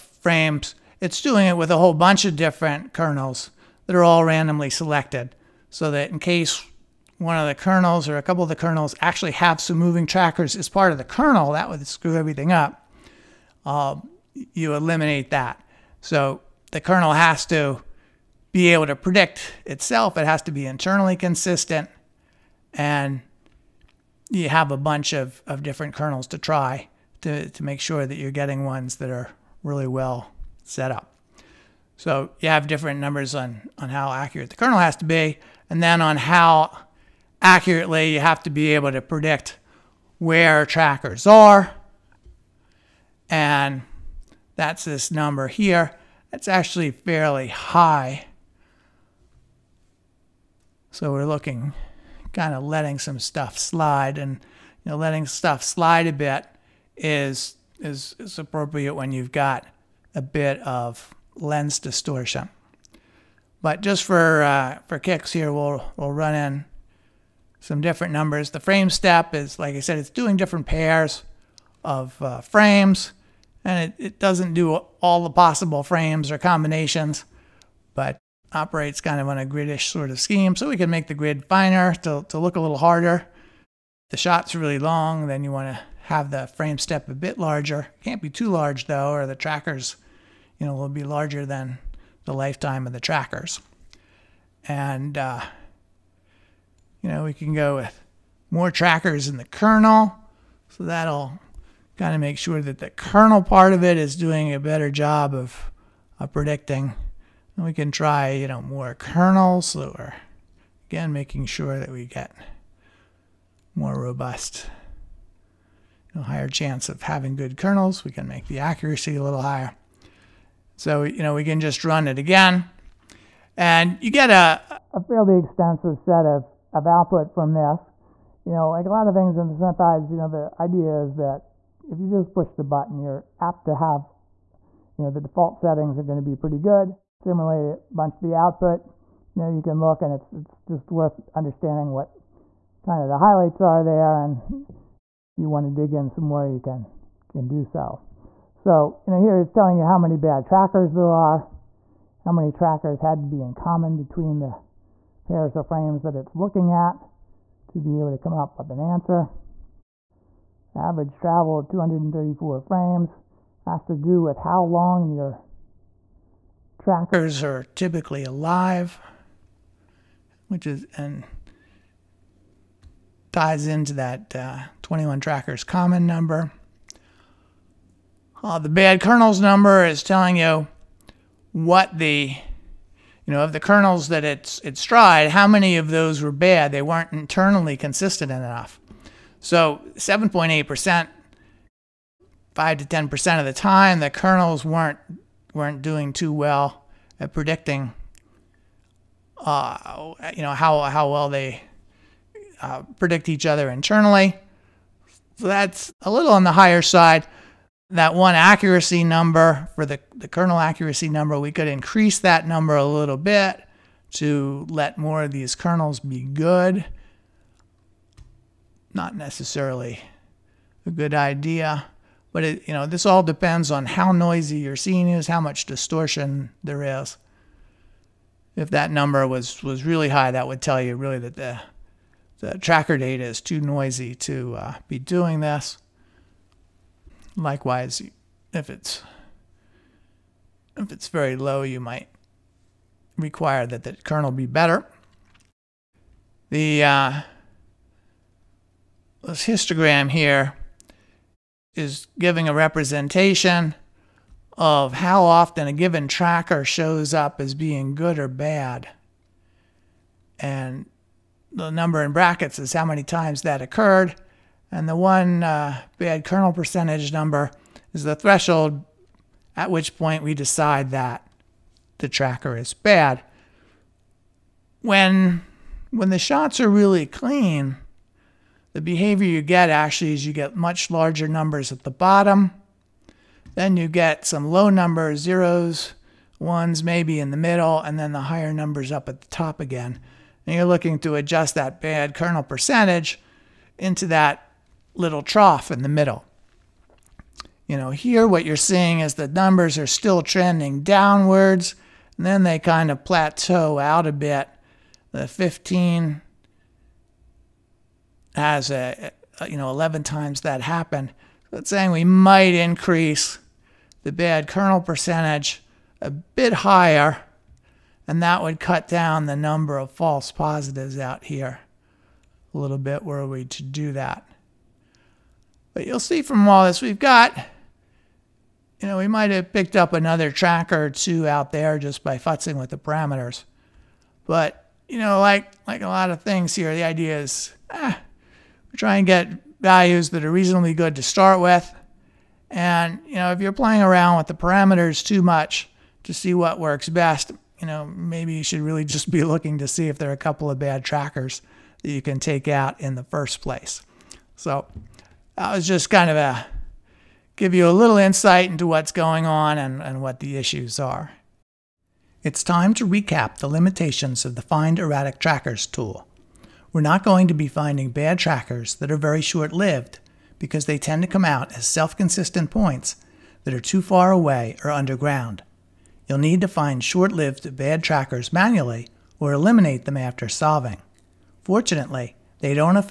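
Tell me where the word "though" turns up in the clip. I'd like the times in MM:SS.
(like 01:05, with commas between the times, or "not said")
01:28.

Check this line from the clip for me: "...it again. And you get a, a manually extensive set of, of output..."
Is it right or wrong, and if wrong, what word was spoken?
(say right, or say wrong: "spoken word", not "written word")
wrong: "fairly", not "manually".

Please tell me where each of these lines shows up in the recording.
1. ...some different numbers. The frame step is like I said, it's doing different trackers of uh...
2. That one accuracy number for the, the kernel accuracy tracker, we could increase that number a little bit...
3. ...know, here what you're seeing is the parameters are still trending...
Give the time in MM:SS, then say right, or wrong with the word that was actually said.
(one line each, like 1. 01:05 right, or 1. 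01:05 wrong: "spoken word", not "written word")
1. 01:07 wrong: "pairs", not "trackers"
2. 03:27 wrong: "number", not "tracker"
3. 04:57 wrong: "numbers", not "parameters".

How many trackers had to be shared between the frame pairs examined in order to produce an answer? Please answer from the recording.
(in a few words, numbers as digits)
21.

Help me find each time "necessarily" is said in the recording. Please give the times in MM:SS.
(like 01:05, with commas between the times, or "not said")
03:39.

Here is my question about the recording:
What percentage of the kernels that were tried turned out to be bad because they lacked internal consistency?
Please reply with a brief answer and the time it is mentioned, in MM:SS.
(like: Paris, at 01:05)
7.8 percent, at 03:09.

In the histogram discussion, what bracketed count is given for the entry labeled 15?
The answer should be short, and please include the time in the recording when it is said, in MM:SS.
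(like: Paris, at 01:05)
11, at 05:09.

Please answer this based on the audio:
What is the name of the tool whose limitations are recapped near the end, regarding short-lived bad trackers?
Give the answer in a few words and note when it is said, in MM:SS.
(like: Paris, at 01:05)
Find Erratic Trackers, at 06:04.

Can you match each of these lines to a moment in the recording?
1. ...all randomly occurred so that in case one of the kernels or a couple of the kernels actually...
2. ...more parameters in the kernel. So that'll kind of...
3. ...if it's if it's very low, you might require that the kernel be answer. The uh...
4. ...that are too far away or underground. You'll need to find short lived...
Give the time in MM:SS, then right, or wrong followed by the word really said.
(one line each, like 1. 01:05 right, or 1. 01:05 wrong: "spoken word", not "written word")
1. 00:04 wrong: "selected", not "occurred"
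2. 01:38 wrong: "trackers", not "parameters"
3. 03:58 wrong: "better", not "answer"
4. 06:13 right.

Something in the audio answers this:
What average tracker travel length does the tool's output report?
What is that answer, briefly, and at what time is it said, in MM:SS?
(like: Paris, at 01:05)
234 frames, at 02:41.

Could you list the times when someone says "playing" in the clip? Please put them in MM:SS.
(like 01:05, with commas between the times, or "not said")
05:43.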